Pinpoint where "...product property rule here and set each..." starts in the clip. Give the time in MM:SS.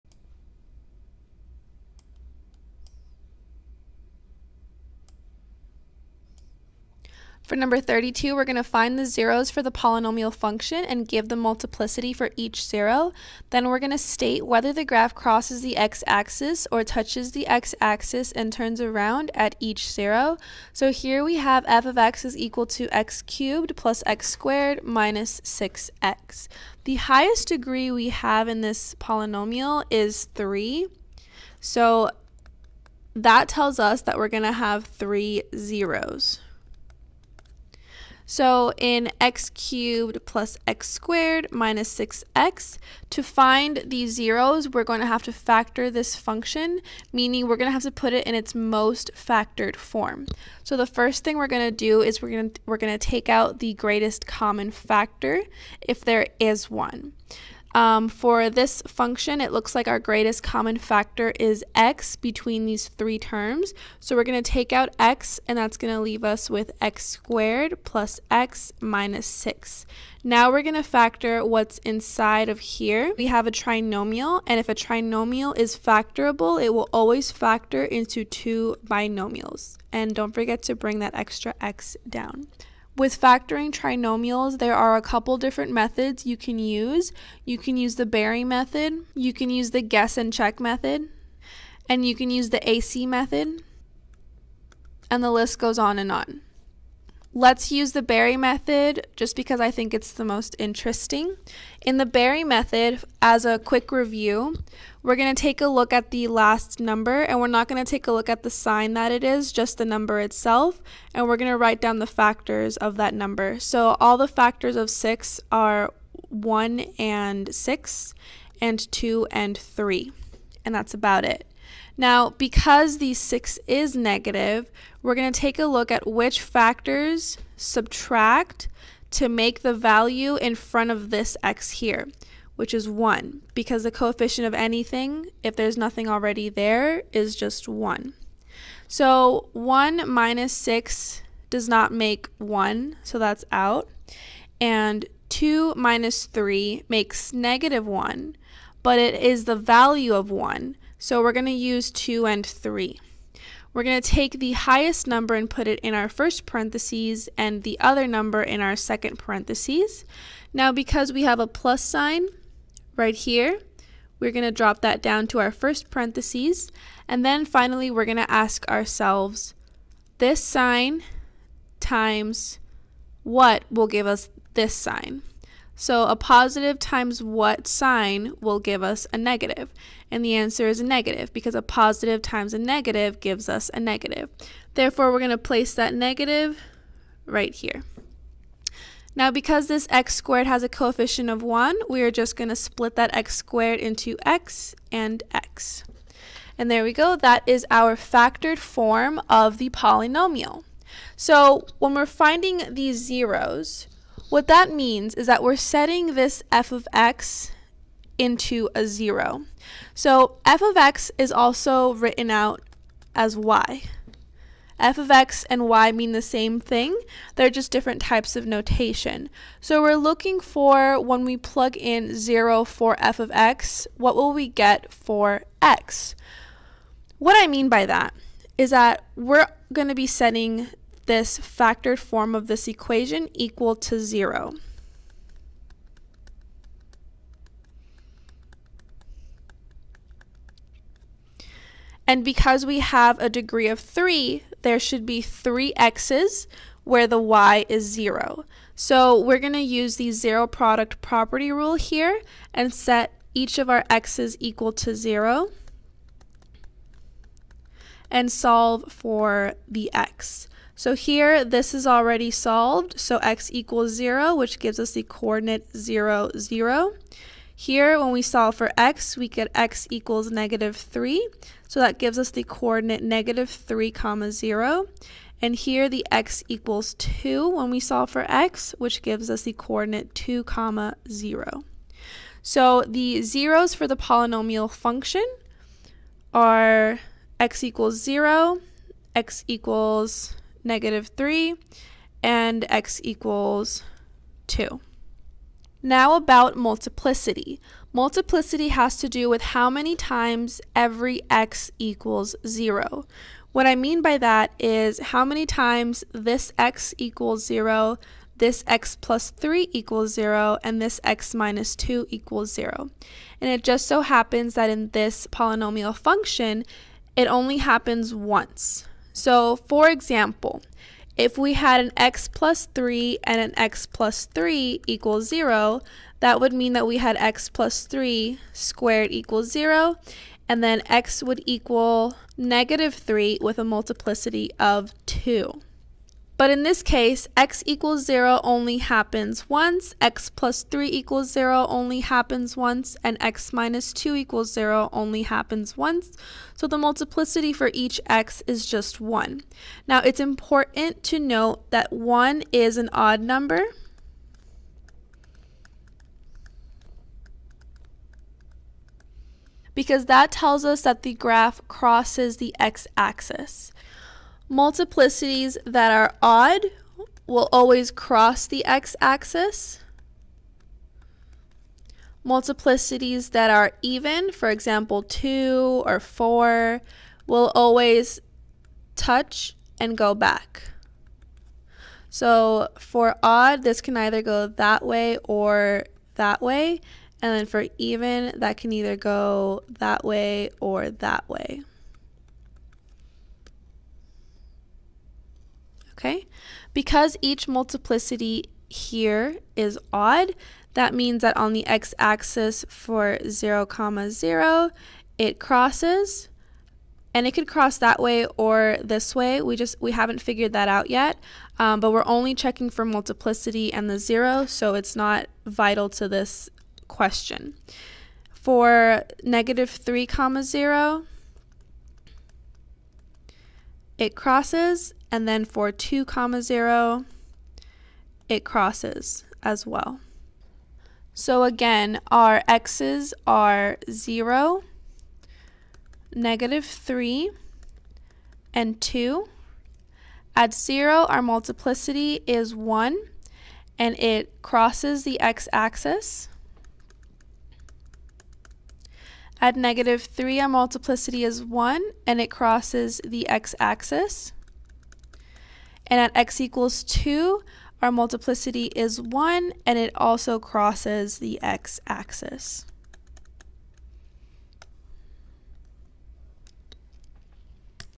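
04:10.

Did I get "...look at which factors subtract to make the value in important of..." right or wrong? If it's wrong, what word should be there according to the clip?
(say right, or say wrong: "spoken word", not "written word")
wrong: "front", not "important".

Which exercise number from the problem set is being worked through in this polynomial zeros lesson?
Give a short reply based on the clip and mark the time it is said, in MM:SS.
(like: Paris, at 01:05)
32, at 00:07.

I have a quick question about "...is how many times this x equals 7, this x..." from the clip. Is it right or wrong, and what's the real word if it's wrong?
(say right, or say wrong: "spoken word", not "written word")
wrong: "0", not "7".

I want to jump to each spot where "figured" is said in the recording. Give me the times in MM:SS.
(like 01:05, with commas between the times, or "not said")
06:50.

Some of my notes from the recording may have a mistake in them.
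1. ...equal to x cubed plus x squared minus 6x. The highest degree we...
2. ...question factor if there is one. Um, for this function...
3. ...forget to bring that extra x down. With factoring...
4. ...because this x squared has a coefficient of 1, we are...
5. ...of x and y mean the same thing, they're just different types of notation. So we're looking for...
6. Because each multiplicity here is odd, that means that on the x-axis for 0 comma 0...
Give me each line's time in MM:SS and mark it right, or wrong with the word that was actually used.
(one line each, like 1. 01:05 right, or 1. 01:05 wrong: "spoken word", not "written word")
1. 00:22 right
2. 00:54 wrong: "common", not "question"
3. 01:20 right
4. 03:09 right
5. 03:34 right
6. 06:36 right.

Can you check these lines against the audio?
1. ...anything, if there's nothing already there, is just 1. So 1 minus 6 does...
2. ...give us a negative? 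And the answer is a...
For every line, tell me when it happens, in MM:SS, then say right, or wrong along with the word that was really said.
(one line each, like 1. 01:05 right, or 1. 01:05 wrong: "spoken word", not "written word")
1. 02:14 right
2. 02:58 right.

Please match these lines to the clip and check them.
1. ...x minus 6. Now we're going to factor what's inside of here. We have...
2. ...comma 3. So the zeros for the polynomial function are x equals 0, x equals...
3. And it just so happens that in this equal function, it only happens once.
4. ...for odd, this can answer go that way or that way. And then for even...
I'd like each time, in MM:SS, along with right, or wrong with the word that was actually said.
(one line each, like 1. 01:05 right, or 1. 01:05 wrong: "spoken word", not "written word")
1. 01:08 right
2. 04:40 wrong: "0", not "3"
3. 05:13 wrong: "polynomial", not "equal"
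4. 06:22 wrong: "either", not "answer".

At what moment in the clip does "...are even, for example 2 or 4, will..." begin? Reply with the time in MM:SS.
06:13.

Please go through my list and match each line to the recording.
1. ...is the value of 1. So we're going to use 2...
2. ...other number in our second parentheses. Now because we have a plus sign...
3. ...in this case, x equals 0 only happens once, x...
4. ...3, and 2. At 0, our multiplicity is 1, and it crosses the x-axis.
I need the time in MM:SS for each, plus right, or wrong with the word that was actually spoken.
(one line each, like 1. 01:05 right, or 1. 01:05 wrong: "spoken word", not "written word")
1. 02:29 right
2. 02:37 right
3. 05:36 right
4. 07:16 right.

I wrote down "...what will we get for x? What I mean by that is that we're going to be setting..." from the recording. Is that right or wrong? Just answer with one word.
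right.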